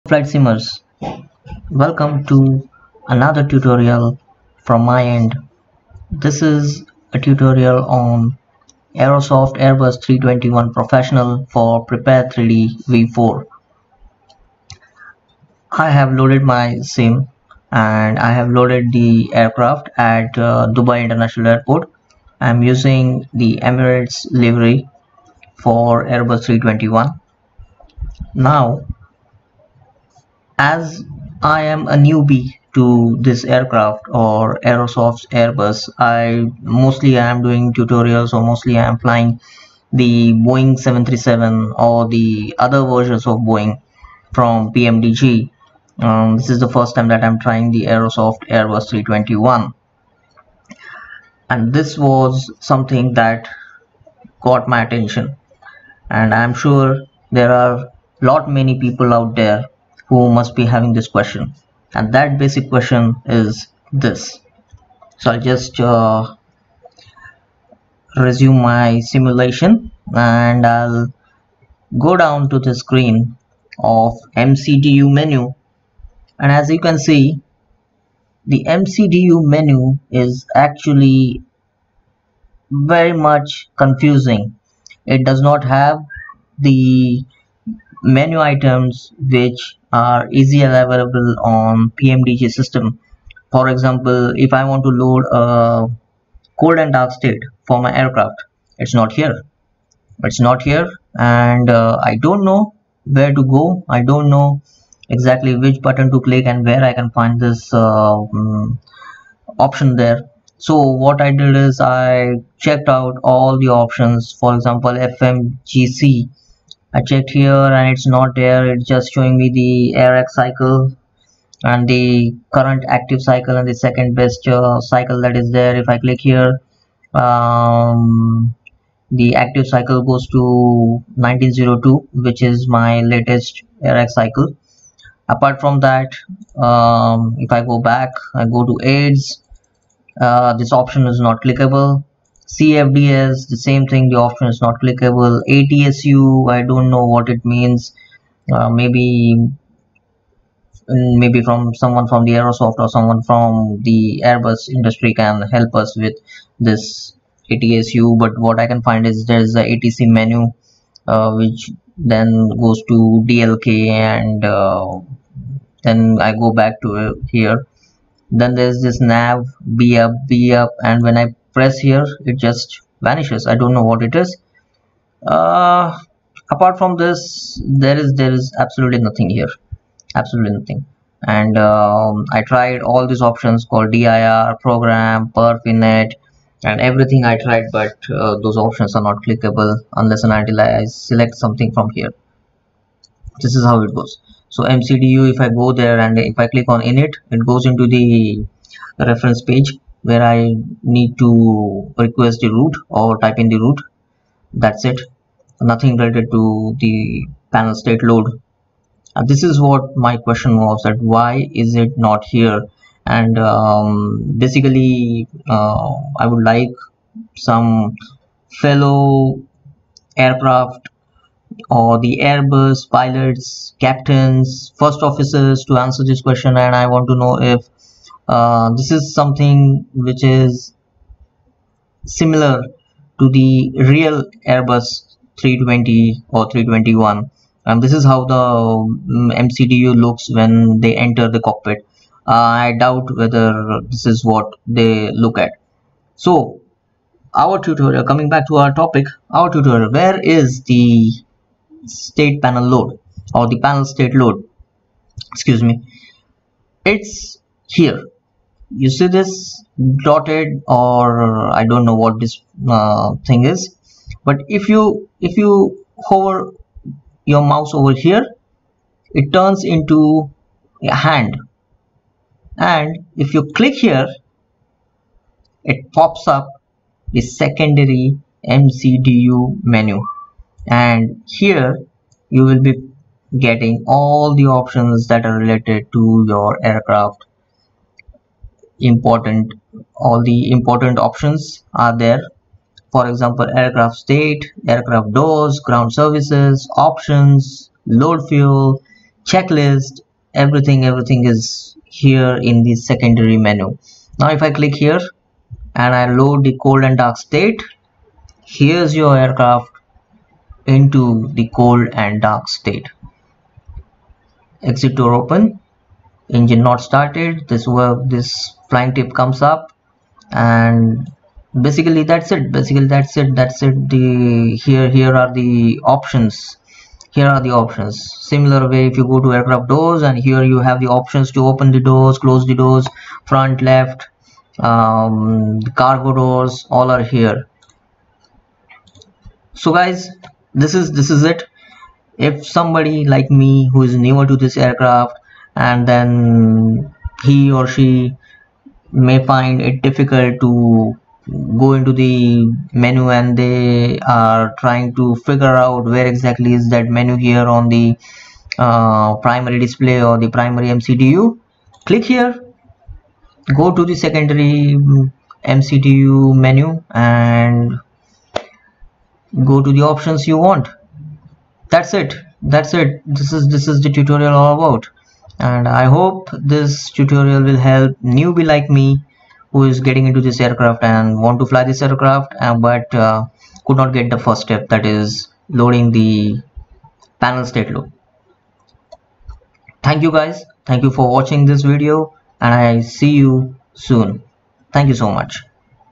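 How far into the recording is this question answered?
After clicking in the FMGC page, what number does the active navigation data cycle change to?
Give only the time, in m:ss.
2:11.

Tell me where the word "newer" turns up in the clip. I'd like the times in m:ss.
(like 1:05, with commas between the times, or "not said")
5:44.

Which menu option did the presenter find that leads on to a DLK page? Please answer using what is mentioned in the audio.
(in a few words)
ATC menu.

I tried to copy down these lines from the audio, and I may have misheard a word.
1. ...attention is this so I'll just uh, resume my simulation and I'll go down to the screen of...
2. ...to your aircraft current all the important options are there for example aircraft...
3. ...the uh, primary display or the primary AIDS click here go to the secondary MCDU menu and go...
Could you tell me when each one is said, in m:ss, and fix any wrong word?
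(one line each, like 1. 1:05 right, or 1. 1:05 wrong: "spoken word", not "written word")
1. 1:02 wrong: "question", not "attention"
2. 4:45 wrong: "important", not "current"
3. 5:57 wrong: "MCDU", not "AIDS".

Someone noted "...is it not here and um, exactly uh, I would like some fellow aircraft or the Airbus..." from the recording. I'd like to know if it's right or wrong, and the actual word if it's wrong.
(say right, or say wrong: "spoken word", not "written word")
wrong: "basically", not "exactly".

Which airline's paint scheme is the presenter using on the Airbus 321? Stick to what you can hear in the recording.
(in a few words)
Emirates.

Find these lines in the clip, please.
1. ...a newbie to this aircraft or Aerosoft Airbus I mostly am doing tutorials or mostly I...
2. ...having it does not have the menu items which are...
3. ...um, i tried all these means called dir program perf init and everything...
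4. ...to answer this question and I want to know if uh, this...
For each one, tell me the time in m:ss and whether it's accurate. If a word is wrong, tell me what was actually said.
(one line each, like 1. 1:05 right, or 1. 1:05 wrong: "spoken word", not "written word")
1. 0:31 right
2. 1:23 wrong: "confusing", not "having"
3. 3:01 wrong: "options", not "means"
4. 3:45 right.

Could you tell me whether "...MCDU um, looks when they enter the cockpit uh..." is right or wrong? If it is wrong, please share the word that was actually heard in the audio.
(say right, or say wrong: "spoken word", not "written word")
right.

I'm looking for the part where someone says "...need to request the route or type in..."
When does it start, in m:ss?
3:20.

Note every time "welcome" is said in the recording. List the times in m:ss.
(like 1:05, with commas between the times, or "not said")
0:01.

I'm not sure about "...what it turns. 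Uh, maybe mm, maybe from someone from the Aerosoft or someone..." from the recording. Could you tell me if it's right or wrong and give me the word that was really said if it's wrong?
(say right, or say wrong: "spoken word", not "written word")
wrong: "means", not "turns".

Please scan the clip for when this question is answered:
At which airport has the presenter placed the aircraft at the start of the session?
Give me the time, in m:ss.
0:20.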